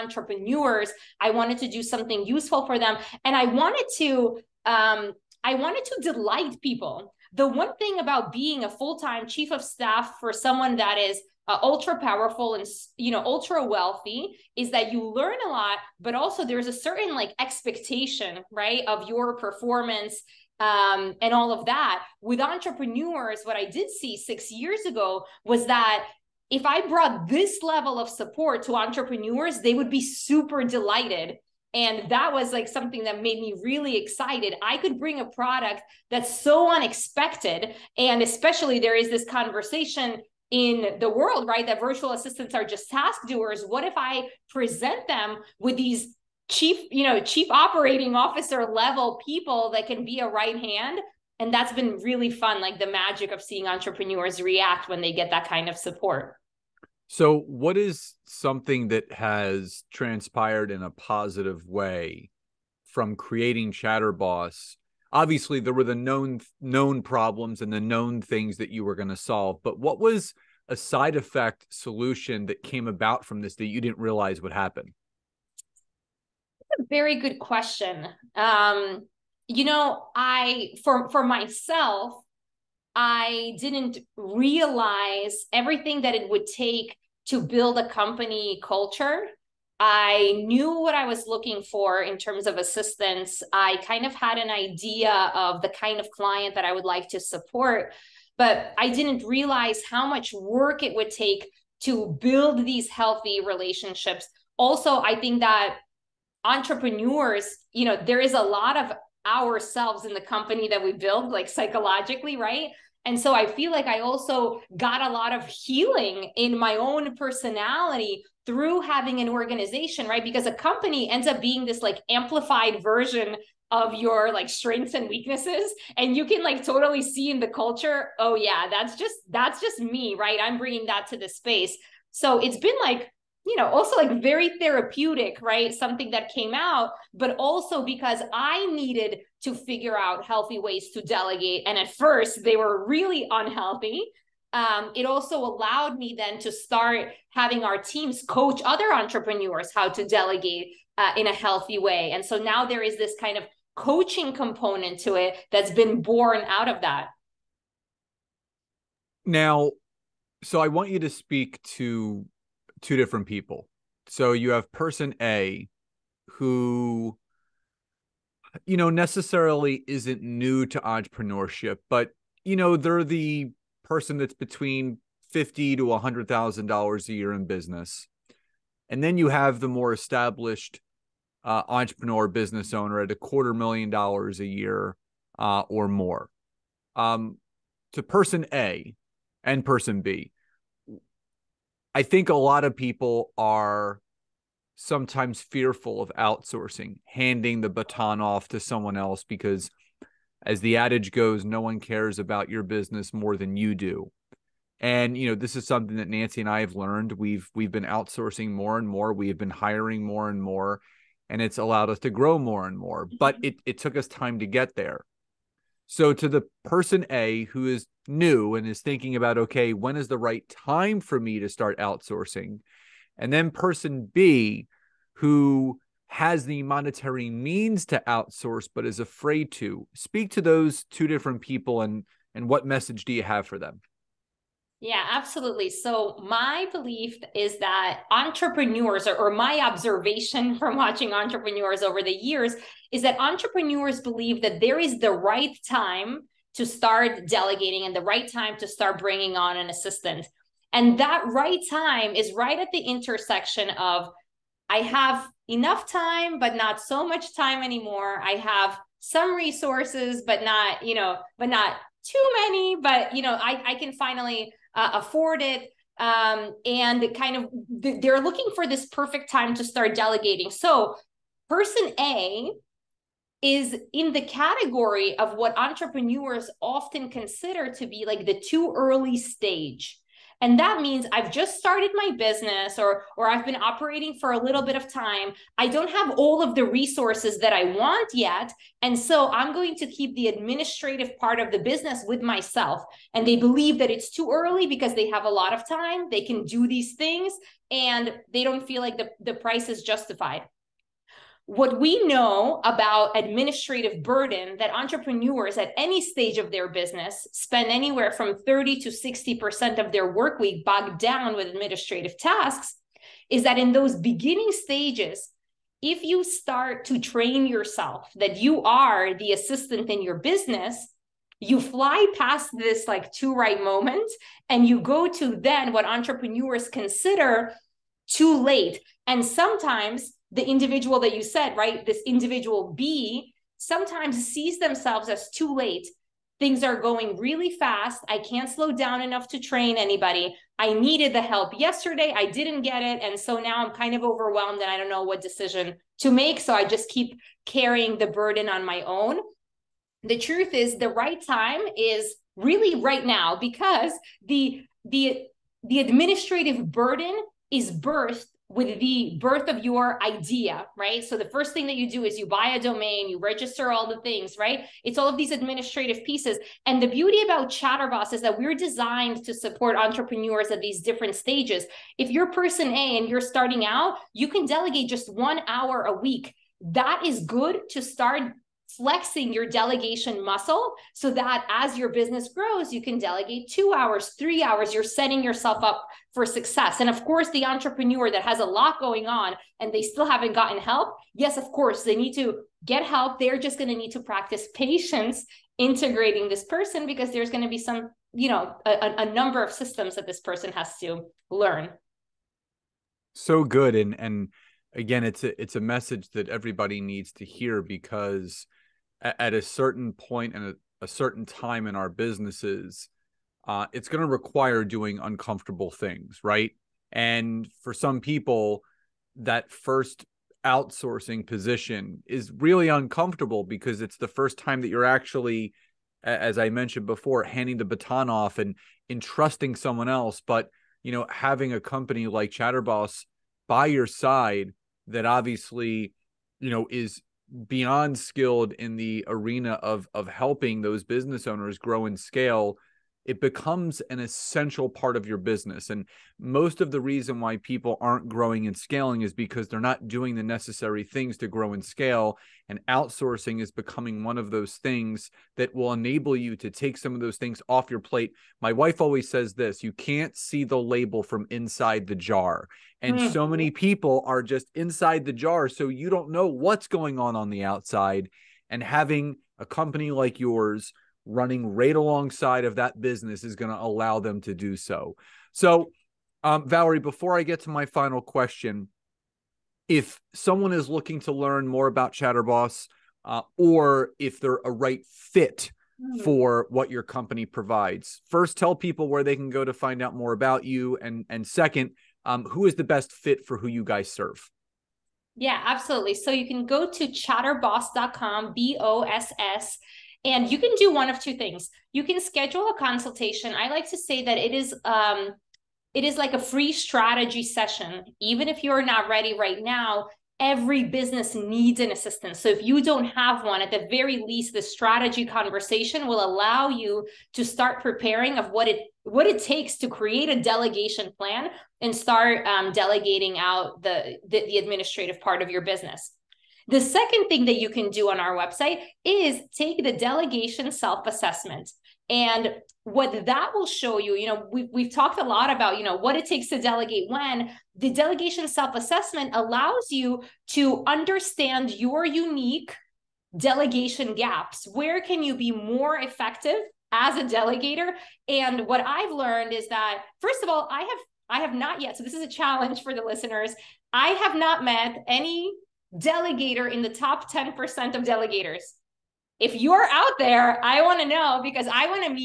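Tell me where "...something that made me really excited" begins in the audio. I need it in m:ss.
0:32.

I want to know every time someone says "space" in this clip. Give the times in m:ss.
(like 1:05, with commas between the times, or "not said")
2:11.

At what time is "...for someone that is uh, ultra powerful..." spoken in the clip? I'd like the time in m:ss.
0:10.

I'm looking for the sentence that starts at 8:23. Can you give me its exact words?
I like to say that it is um, it is like a free strategy session.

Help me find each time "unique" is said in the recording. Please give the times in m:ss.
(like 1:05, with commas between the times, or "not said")
9:01.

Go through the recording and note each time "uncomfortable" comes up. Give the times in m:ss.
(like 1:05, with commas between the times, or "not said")
6:54, 7:02.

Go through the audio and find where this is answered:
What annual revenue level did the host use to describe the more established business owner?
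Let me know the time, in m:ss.
3:03.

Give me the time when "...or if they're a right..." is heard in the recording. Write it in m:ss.
8:03.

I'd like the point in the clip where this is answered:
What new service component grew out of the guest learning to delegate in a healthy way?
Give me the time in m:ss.
2:33.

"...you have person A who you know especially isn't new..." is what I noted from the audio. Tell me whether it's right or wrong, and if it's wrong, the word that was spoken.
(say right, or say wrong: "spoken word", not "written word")
wrong: "necessarily", not "especially".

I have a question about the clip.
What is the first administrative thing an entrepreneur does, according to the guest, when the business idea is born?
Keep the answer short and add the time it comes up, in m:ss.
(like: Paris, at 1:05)
buy a domain, at 6:02.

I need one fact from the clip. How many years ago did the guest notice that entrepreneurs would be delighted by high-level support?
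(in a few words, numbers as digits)
6.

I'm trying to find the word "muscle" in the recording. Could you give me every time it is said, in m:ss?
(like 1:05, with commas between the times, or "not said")
6:20.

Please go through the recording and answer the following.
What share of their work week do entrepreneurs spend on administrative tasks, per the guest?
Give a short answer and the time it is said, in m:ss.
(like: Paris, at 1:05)
30 to 60%, at 5:08.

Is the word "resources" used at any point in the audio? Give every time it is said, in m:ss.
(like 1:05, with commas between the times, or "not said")
4:19, 4:46.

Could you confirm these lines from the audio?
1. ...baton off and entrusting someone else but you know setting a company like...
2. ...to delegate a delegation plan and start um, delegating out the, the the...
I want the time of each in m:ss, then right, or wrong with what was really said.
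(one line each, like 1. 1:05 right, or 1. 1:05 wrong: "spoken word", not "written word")
1. 7:07 wrong: "having", not "setting"
2. 8:39 wrong: "create", not "delegate".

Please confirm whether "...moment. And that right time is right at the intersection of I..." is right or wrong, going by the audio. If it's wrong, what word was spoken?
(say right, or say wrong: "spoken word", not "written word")
wrong: "assistant", not "moment".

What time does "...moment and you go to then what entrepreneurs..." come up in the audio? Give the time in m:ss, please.
5:23.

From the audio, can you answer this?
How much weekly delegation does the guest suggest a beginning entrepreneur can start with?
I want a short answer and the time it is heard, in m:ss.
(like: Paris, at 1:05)
one hour, at 6:15.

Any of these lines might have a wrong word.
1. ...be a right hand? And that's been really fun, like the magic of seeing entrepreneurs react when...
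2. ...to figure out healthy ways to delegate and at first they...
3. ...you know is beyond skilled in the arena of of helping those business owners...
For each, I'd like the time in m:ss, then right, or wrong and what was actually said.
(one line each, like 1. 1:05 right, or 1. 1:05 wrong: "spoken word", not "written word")
1. 0:50 right
2. 2:19 right
3. 7:16 right.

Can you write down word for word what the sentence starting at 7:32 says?
And outsourcing is becoming one of those things that will enable you to take some of those things off your plate.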